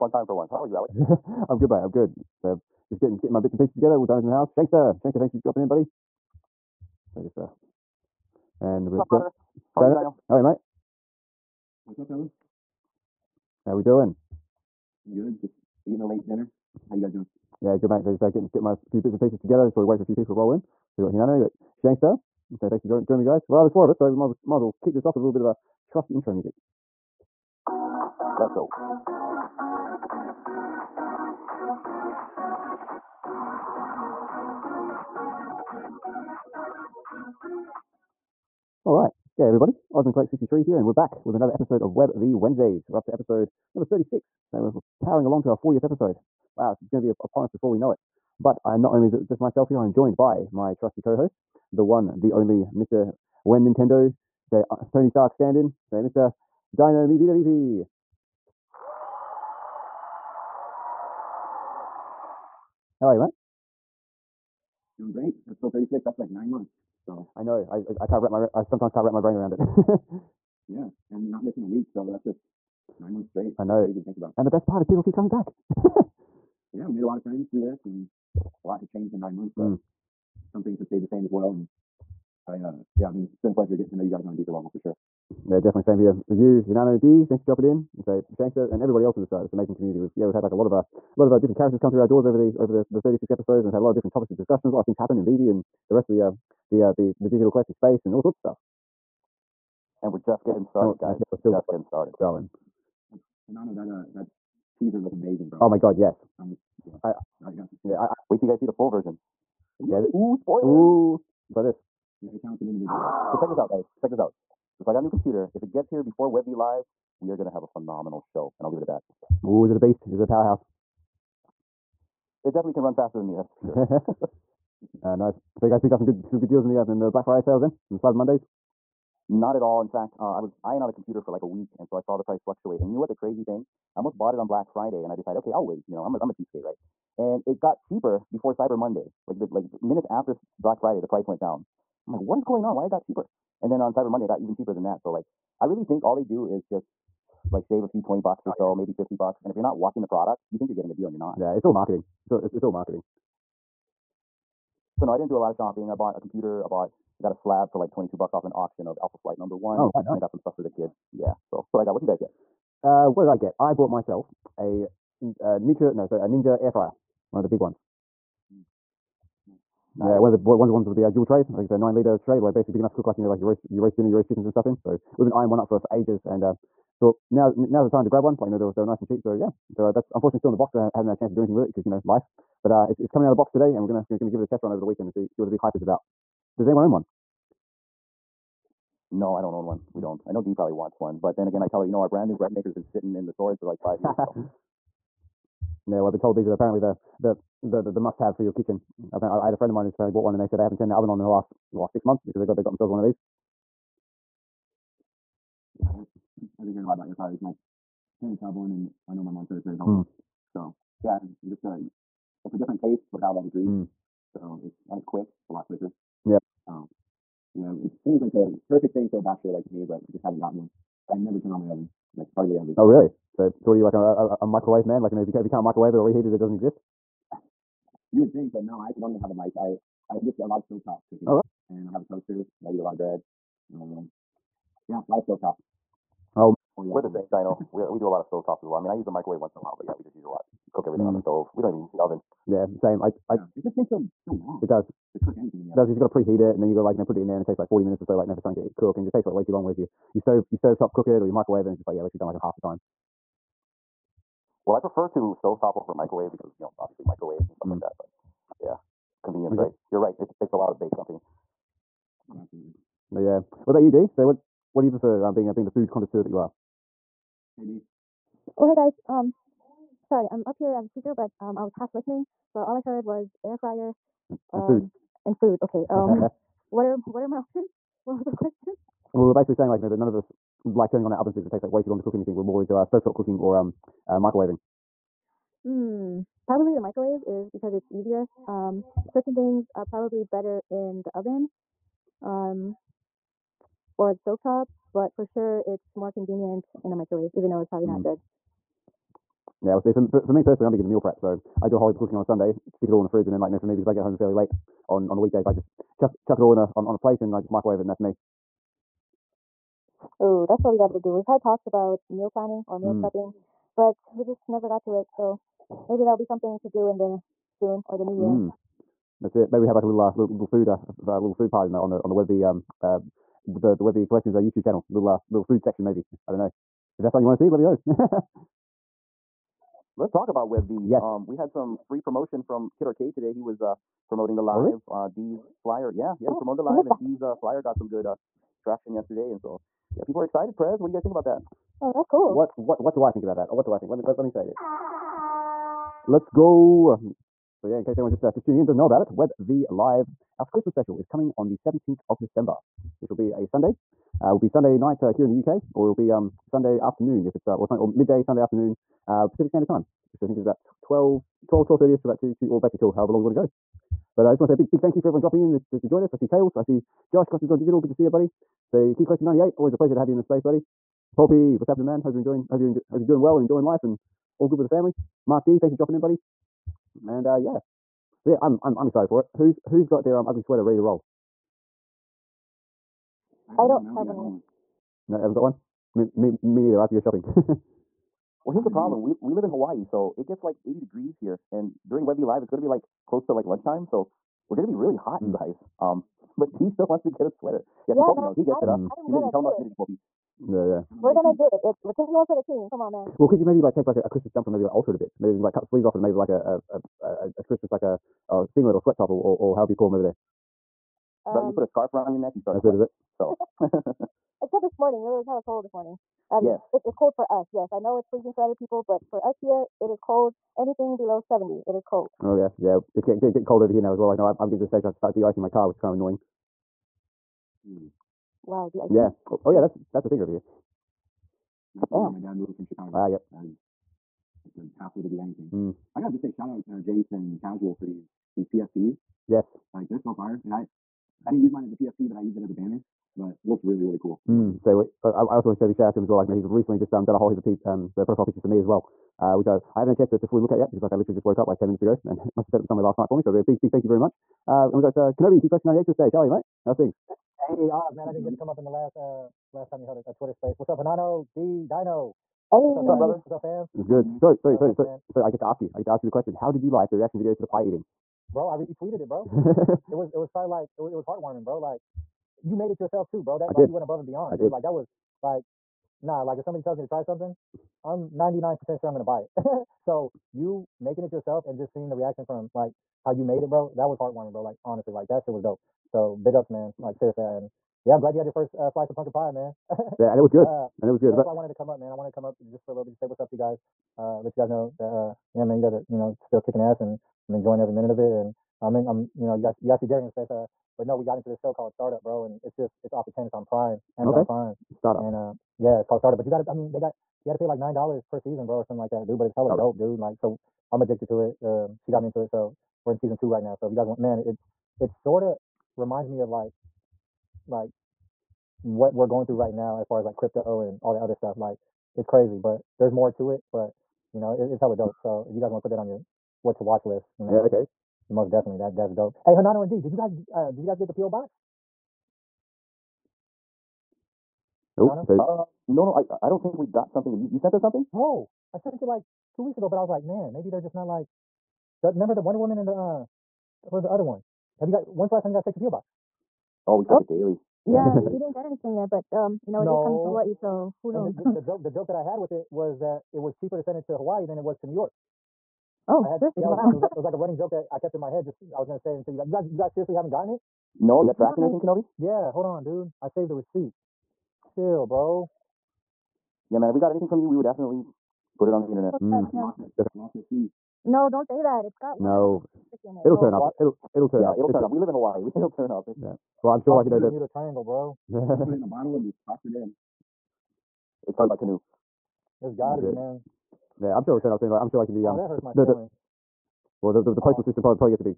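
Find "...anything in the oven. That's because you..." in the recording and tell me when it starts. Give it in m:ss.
4:05.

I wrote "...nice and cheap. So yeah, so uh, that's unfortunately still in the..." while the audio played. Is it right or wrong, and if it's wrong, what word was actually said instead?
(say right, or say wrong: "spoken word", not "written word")
right.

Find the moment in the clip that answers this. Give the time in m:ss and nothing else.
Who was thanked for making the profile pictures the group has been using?
7:16.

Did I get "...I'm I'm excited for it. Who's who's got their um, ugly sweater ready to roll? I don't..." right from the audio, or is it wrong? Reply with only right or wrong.
right.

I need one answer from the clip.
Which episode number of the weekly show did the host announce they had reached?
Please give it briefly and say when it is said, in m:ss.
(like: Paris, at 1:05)
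36, at 0:43.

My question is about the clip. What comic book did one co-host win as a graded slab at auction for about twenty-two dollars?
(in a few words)
Alpha Flight number one.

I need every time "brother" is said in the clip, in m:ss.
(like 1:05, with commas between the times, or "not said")
0:09, 7:42.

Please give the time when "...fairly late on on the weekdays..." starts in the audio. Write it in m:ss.
5:04.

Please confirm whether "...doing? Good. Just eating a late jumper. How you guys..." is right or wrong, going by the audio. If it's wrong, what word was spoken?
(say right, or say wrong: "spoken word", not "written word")
wrong: "dinner", not "jumper".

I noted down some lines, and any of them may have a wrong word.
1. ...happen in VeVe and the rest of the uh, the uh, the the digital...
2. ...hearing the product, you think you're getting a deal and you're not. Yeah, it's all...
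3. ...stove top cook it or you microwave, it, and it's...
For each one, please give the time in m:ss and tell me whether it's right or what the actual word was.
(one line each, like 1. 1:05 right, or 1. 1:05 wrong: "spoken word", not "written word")
1. 1:34 right
2. 2:29 wrong: "watching", not "hearing"
3. 4:10 right.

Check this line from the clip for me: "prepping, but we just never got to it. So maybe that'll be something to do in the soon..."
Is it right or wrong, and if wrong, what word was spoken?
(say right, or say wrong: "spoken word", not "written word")
right.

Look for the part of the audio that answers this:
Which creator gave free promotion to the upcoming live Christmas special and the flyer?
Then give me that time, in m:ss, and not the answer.
5:32.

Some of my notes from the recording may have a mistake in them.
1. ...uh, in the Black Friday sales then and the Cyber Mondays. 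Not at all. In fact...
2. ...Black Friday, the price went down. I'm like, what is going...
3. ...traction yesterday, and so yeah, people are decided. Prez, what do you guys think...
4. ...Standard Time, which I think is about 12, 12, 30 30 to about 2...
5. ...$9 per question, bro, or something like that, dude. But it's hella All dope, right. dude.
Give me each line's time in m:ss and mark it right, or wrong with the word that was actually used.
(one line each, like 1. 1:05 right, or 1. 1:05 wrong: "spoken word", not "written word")
1. 2:06 right
2. 2:20 right
3. 5:38 wrong: "excited", not "decided"
4. 5:59 right
5. 8:27 wrong: "season", not "question".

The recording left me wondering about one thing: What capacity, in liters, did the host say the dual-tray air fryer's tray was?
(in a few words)
9.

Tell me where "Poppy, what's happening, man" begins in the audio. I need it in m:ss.
6:11.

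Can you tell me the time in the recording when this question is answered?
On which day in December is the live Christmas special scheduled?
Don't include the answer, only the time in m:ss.
5:51.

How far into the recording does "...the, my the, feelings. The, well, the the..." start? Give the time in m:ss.
9:45.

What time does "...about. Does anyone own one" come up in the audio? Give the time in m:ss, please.
3:05.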